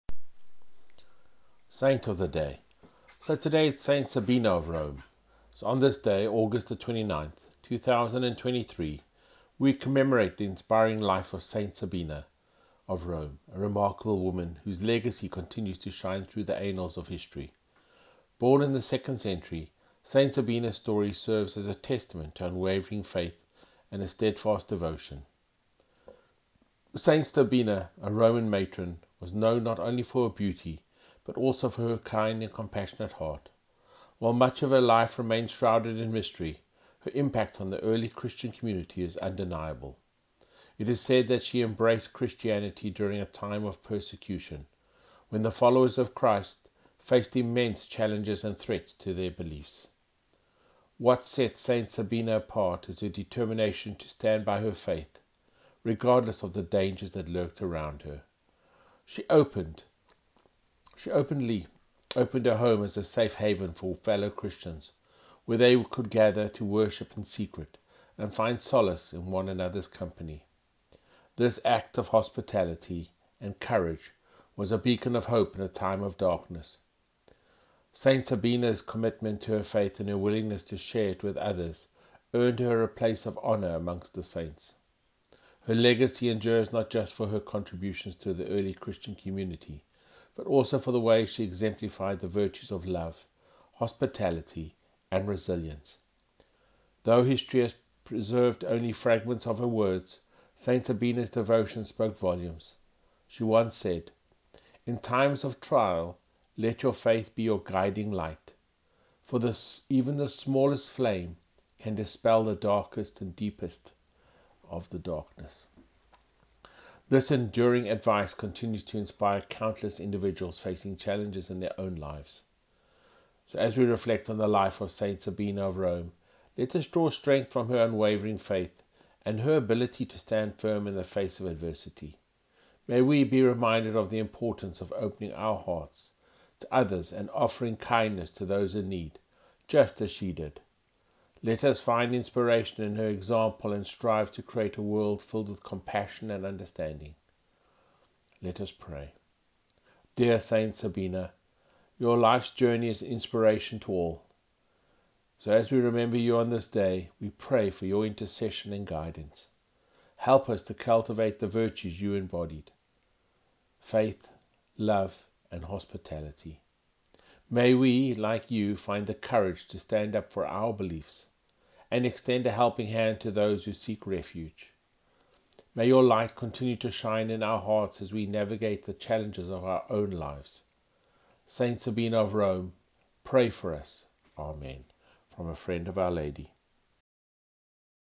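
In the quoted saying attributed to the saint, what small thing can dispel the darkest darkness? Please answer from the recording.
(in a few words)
The smallest flame.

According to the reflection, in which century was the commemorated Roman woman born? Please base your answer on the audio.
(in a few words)
2nd century.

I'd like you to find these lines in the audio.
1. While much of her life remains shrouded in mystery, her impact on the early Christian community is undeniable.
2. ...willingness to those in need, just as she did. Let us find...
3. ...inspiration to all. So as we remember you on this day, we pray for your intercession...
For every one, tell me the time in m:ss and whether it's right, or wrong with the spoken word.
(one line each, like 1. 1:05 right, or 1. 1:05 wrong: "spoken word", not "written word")
1. 0:34 right
2. 2:17 wrong: "kindness", not "willingness"
3. 2:33 right.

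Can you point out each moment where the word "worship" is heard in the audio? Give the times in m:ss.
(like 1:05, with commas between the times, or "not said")
1:06.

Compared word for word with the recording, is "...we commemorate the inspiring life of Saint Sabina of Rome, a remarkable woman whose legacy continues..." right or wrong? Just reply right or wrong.
right.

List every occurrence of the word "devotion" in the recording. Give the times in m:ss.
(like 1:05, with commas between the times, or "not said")
0:24, 1:41.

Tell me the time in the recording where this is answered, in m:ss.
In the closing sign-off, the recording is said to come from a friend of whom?
3:05.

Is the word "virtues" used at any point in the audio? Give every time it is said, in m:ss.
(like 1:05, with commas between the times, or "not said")
1:32, 2:41.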